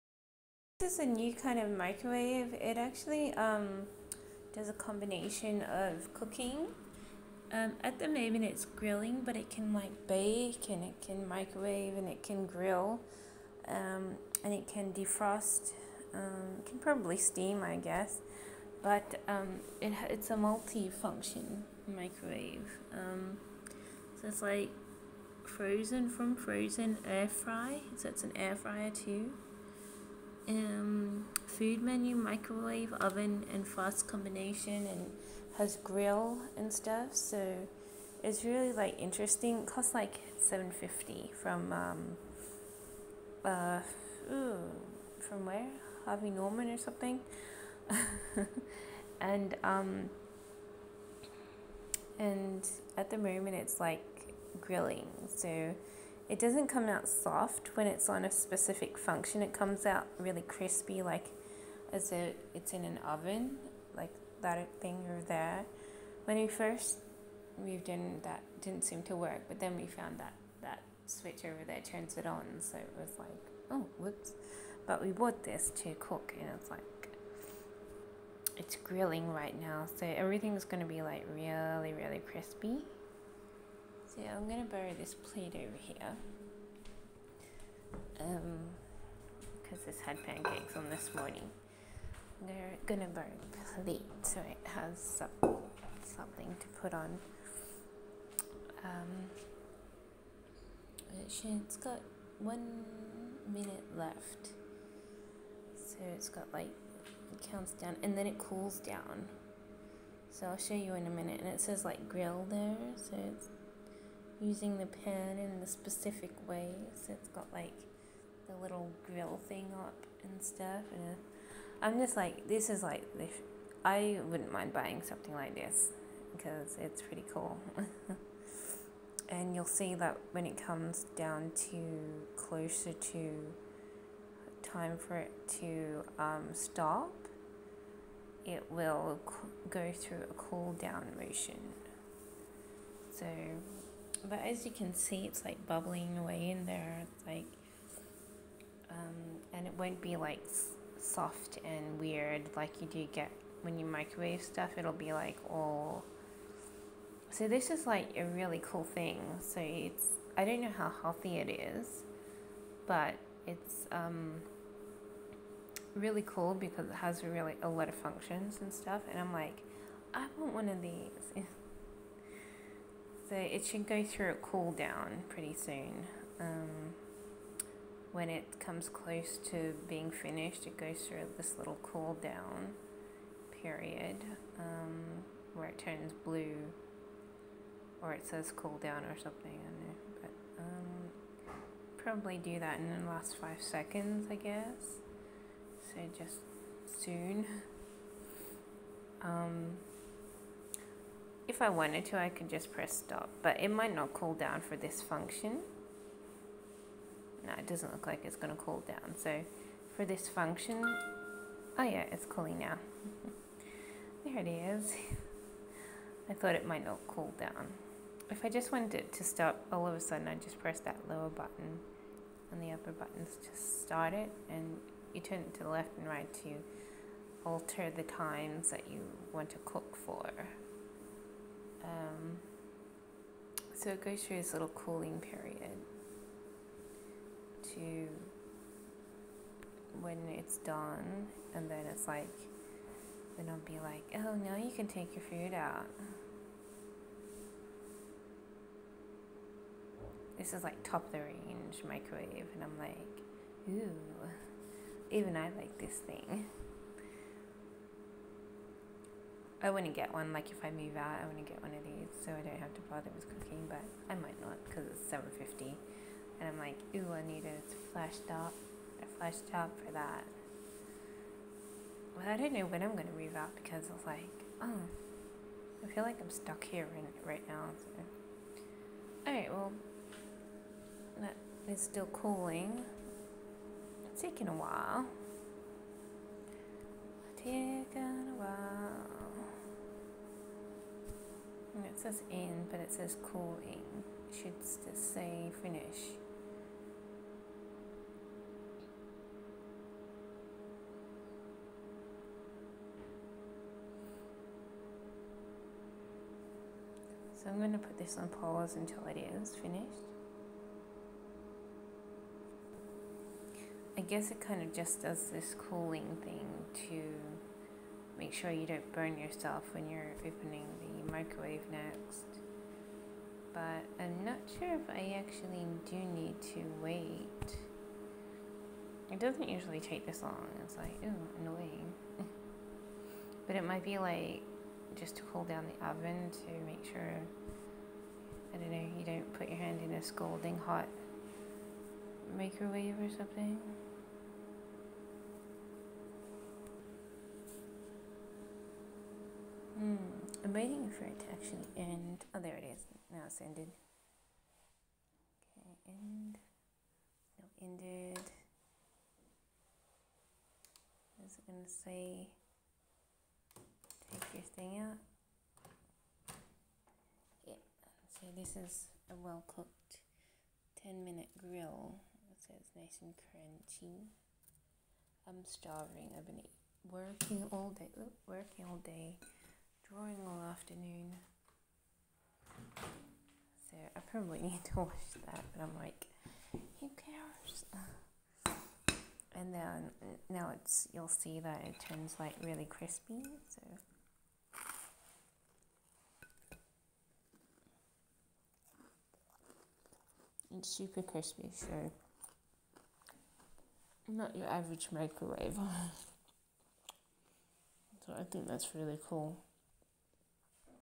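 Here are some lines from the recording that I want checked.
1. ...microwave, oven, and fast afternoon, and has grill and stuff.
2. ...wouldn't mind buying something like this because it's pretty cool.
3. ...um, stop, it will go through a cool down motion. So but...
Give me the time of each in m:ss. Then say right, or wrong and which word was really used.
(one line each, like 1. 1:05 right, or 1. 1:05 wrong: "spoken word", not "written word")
1. 0:32 wrong: "combination", not "afternoon"
2. 2:04 right
3. 2:16 right.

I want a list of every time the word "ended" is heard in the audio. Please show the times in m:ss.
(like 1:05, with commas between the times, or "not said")
5:53, 5:57.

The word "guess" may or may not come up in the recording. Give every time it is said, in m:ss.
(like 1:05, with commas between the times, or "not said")
0:17, 3:14, 5:14.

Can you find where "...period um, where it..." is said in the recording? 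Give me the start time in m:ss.
3:03.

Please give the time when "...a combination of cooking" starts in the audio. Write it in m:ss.
0:04.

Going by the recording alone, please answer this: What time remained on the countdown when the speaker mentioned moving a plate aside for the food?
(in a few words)
1 minute.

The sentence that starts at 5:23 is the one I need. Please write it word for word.
But I'm not sure if I actually do need to wait.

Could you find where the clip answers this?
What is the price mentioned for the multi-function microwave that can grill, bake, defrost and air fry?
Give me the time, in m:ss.
0:40.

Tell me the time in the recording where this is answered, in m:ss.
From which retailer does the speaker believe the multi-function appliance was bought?
0:46.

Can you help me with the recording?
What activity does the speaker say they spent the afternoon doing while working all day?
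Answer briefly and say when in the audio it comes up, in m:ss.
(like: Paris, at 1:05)
Drawing, at 6:19.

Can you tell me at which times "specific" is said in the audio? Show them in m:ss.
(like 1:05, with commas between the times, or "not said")
0:58, 1:55.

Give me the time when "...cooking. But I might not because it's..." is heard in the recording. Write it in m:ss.
4:23.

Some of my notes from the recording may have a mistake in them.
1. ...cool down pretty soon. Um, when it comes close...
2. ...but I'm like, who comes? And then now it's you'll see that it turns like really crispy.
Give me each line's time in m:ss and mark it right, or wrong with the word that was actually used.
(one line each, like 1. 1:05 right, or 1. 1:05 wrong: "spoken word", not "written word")
1. 2:54 right
2. 6:25 wrong: "cares", not "comes".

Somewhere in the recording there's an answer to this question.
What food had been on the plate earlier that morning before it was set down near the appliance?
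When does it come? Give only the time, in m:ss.
1:30.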